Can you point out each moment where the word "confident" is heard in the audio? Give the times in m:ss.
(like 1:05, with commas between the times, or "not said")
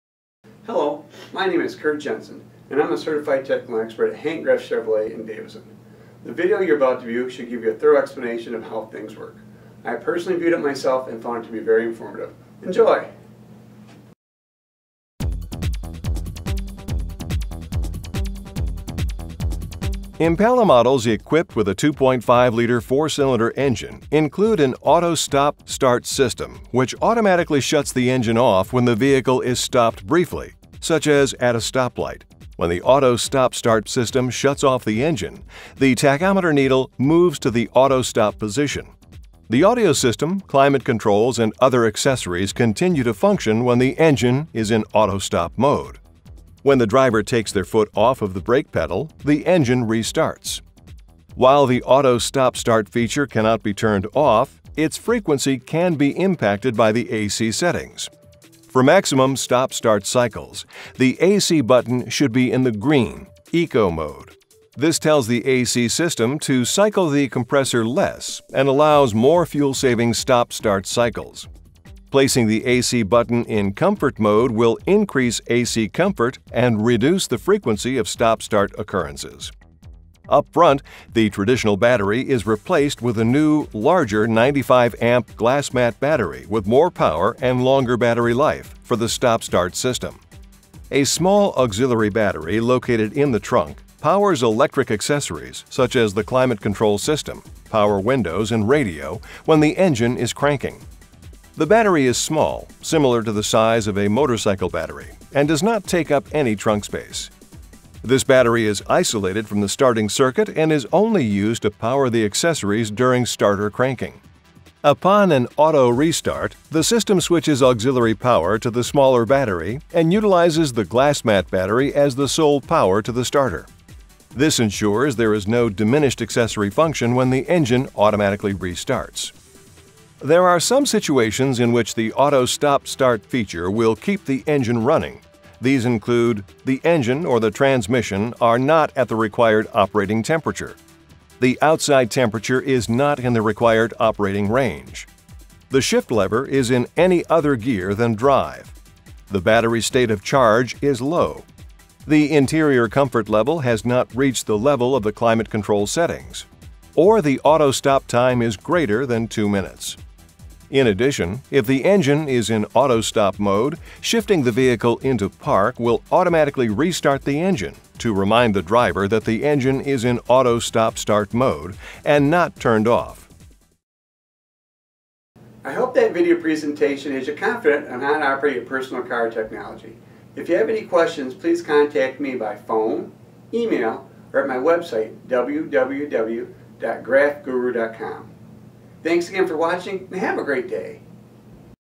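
2:57.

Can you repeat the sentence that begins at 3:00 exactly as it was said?
If you have any questions, please contact me by phone, email, or at my website, www.graffguru.com.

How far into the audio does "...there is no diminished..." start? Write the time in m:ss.
2:05.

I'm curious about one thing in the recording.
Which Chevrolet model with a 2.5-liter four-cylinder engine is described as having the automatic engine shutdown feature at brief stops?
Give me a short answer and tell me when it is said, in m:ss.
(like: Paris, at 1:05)
Impala, at 0:20.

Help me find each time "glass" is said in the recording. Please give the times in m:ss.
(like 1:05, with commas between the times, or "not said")
1:25, 2:00.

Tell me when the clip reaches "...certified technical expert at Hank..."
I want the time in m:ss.
0:02.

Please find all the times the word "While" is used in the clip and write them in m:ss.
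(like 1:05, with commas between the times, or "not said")
0:51.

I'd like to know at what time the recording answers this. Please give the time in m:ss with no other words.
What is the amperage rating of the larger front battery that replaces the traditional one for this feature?
1:24.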